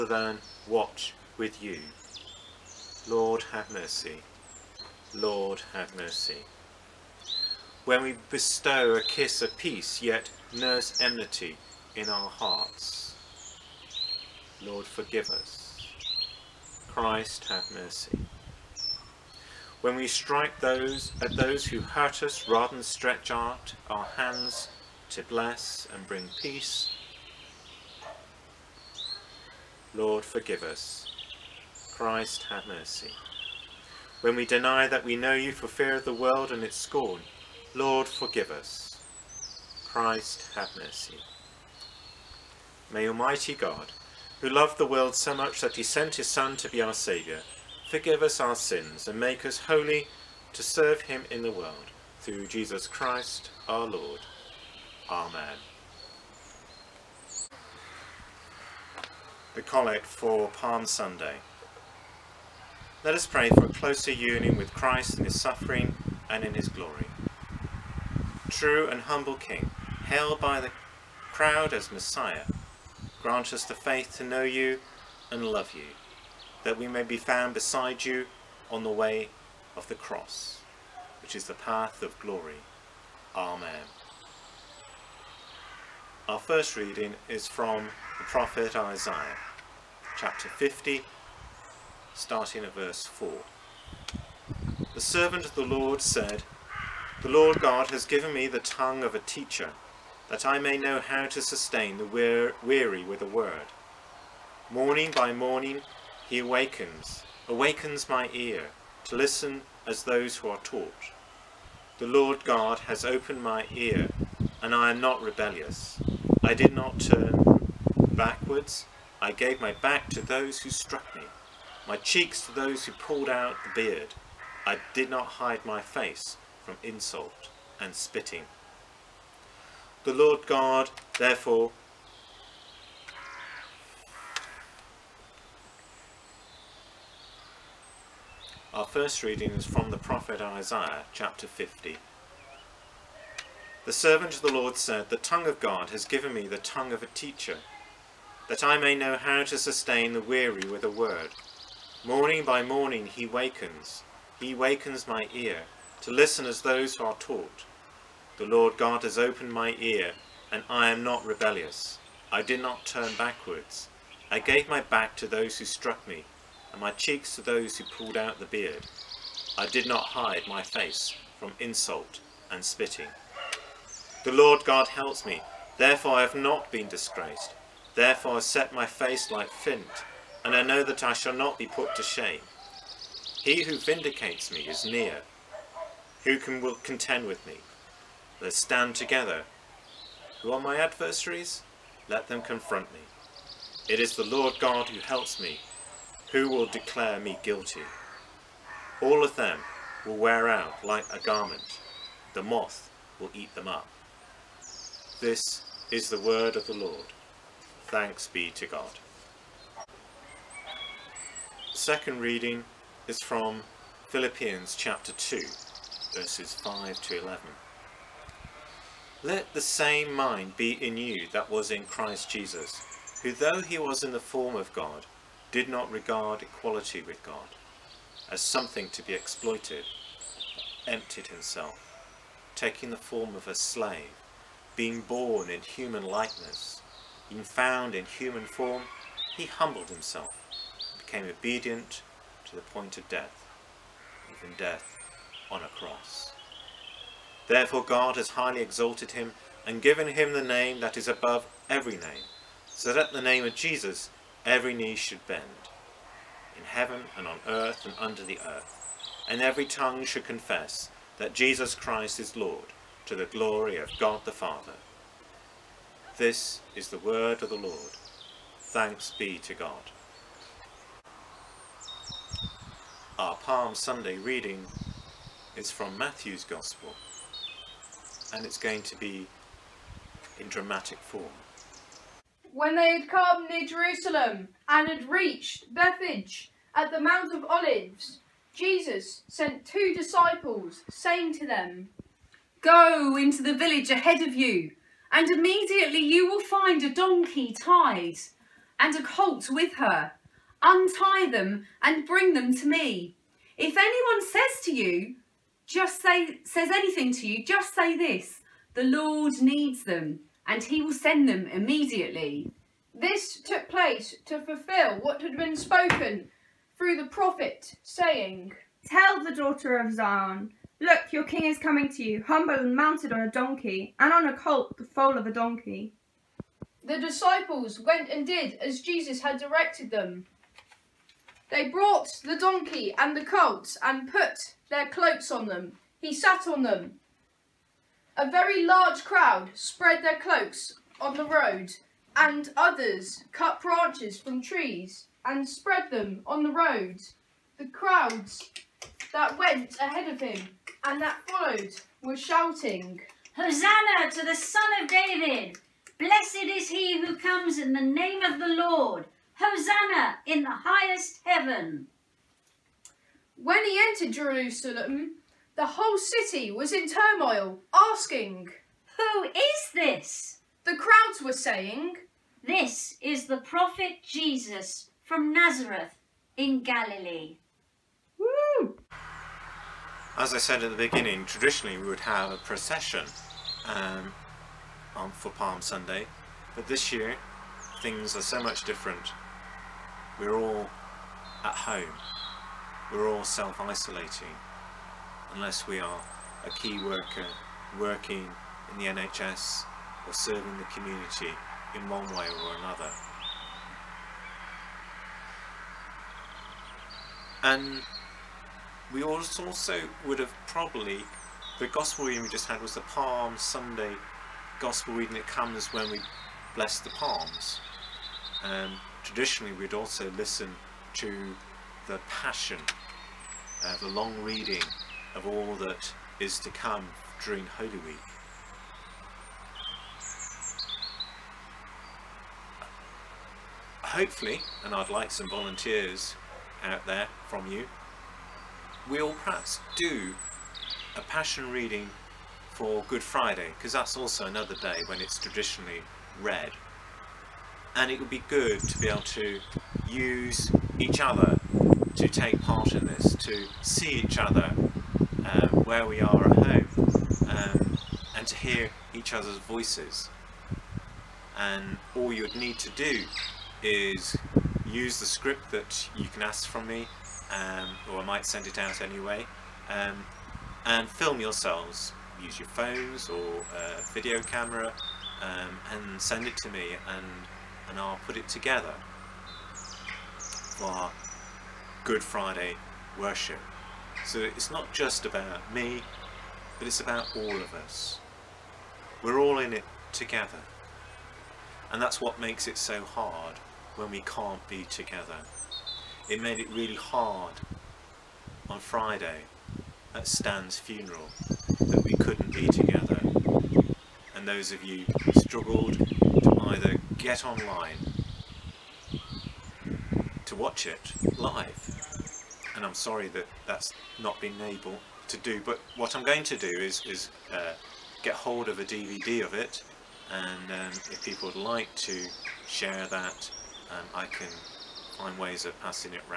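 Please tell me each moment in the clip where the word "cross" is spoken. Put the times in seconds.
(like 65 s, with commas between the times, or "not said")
79 s, 245 s.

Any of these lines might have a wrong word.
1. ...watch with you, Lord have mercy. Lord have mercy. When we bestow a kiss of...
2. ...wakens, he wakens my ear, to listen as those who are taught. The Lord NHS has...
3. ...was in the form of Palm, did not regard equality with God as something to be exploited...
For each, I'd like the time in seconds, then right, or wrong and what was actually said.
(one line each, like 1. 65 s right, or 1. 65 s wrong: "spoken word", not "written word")
1. 0 s right
2. 153 s wrong: "God", not "NHS"
3. 223 s wrong: "God", not "Palm".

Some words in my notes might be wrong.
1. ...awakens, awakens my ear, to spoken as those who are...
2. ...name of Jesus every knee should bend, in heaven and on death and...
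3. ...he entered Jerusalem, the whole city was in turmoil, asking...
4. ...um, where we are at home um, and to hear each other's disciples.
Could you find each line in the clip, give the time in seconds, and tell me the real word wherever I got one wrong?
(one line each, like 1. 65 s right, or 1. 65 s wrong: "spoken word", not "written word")
1. 106 s wrong: "listen", not "spoken"
2. 253 s wrong: "earth", not "death"
3. 363 s right
4. 455 s wrong: "voices", not "disciples".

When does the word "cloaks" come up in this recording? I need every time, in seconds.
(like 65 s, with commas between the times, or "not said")
334 s, 340 s.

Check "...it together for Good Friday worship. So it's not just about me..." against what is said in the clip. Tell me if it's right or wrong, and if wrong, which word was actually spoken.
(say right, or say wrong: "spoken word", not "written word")
right.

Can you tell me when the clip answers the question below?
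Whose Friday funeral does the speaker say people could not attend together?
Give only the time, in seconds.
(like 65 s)
500 s.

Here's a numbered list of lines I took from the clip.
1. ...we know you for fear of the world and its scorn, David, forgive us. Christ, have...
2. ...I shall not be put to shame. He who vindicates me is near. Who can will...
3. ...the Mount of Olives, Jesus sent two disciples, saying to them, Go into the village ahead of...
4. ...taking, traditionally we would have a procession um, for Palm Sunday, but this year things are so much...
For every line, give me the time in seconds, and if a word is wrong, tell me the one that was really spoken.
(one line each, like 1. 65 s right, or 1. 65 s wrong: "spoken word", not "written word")
1. 35 s wrong: "Lord", not "David"
2. 181 s right
3. 286 s right
4. 380 s wrong: "beginning", not "taking".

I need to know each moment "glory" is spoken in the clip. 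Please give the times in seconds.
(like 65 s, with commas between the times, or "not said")
66 s, 82 s, 263 s.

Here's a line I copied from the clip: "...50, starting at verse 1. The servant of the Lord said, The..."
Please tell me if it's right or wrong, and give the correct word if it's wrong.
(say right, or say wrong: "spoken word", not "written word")
wrong: "4", not "1".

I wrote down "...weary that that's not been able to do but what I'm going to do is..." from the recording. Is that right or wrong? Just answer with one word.
wrong.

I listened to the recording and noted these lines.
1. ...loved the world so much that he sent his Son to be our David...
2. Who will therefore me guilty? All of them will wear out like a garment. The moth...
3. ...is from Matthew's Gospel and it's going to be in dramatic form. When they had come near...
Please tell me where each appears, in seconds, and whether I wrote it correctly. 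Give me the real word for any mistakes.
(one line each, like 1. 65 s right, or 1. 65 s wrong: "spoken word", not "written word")
1. 44 s wrong: "Saviour", not "David"
2. 196 s wrong: "declare", not "therefore"
3. 275 s right.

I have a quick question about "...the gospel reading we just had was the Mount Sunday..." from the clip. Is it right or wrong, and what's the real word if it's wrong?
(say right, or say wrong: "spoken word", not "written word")
wrong: "Palm", not "Mount".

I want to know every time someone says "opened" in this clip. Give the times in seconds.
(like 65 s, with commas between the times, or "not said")
113 s, 159 s.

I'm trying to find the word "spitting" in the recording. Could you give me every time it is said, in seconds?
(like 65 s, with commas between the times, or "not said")
127 s, 172 s.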